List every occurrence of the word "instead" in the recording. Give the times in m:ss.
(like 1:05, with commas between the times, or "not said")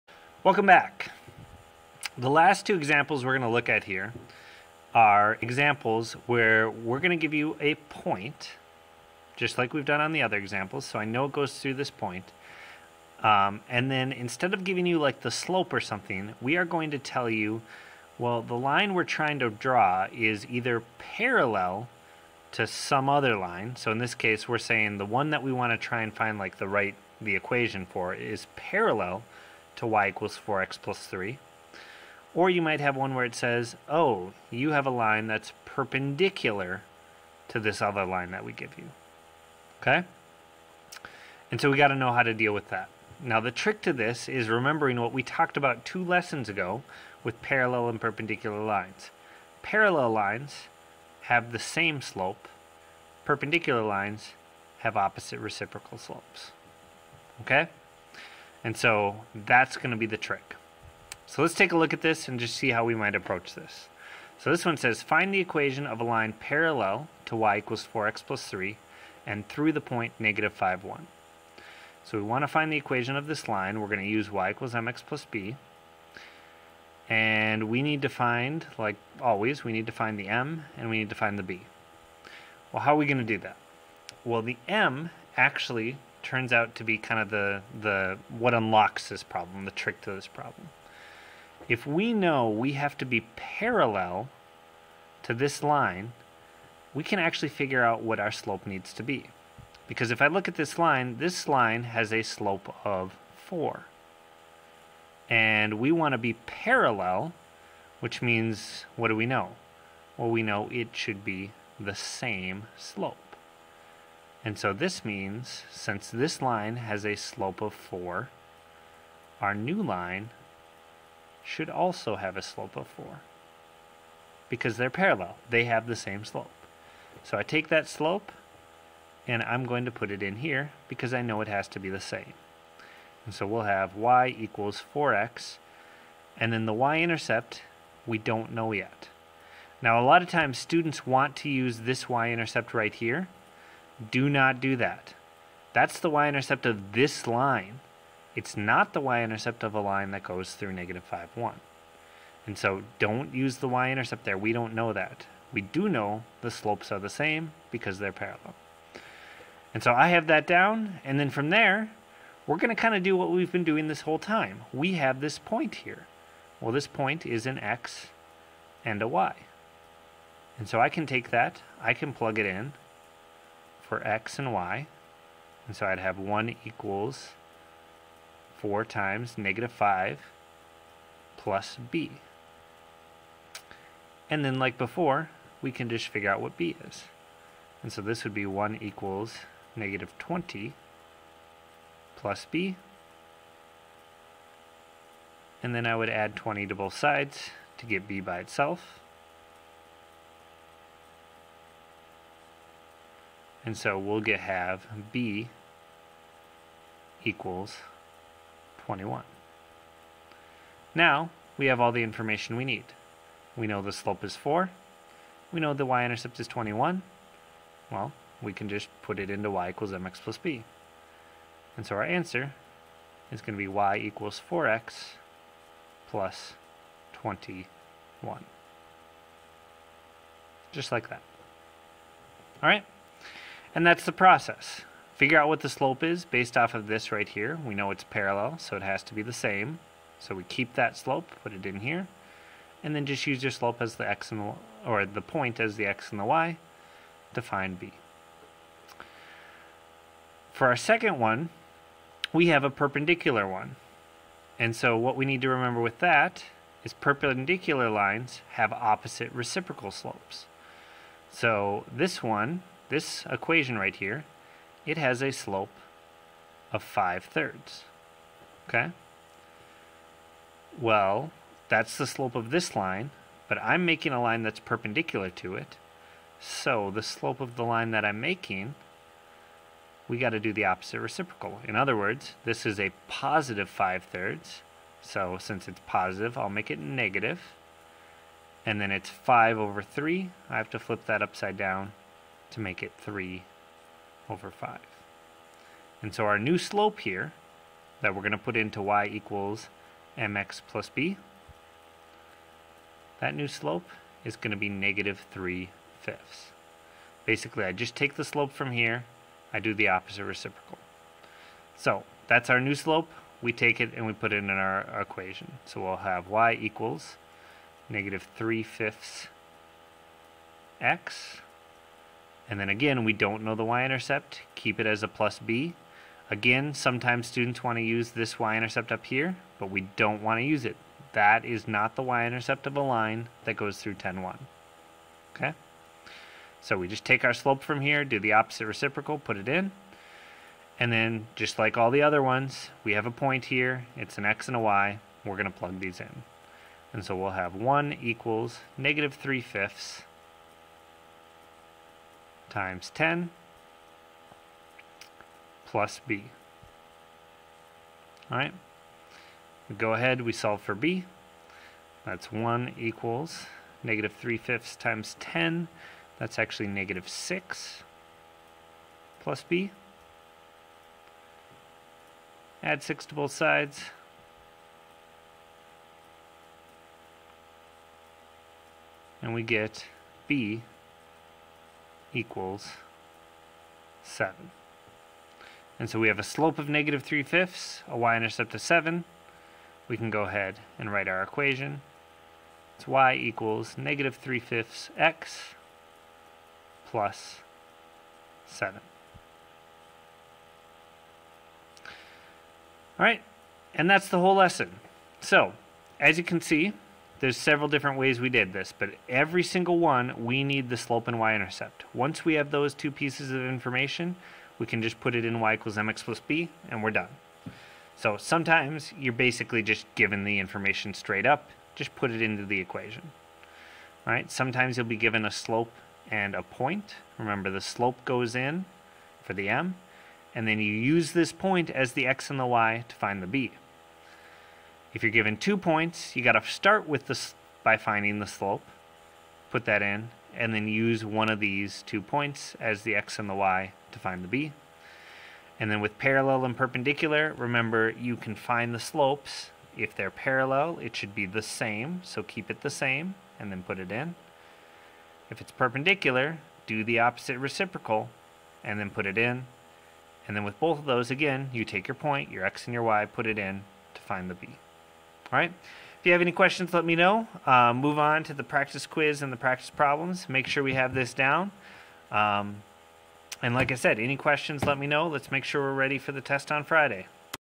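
0:14.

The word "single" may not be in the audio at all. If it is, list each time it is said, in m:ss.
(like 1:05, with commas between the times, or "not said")
6:49.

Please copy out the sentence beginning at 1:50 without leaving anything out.
Well, we know it should be the same slope.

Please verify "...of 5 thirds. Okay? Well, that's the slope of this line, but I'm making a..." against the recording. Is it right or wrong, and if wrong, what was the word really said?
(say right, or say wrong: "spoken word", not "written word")
right.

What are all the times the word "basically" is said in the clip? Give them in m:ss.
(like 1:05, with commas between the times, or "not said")
5:07, 6:59.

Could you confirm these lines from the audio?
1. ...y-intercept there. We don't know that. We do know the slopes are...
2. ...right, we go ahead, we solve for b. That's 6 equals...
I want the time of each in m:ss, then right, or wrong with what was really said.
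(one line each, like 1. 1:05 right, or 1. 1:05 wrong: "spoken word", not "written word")
1. 2:33 right
2. 5:58 wrong: "1", not "6".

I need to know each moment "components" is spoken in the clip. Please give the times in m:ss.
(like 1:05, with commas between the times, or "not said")
not said.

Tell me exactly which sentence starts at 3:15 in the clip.
And then I would add 20 to both sides to get b by itself.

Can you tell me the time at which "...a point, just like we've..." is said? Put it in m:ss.
0:07.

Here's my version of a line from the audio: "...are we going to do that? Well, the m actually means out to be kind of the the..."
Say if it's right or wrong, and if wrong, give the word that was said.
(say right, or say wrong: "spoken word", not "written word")
wrong: "turns", not "means".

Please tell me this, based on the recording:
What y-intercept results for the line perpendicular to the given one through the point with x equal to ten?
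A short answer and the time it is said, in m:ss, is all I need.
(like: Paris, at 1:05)
7, at 6:20.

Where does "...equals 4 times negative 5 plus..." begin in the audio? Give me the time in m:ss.
2:56.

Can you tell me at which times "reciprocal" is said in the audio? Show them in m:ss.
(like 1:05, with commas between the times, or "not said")
0:55, 4:19, 4:40, 5:10, 5:38, 7:37.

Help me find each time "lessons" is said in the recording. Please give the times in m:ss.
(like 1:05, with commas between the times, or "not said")
0:46, 6:44.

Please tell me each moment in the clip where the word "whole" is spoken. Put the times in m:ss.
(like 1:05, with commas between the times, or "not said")
2:44, 6:44.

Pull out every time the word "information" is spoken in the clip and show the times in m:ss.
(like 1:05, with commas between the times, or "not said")
3:32, 6:53, 7:00.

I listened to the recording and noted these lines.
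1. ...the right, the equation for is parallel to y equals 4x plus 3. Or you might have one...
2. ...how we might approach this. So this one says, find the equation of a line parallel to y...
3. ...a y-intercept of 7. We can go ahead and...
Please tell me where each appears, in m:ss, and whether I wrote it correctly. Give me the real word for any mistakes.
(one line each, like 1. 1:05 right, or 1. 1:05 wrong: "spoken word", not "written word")
1. 0:26 right
2. 1:02 right
3. 6:27 right.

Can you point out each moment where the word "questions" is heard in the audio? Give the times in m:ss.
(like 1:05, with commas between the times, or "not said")
7:46, 7:54.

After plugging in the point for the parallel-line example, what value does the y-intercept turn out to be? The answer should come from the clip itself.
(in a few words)
21.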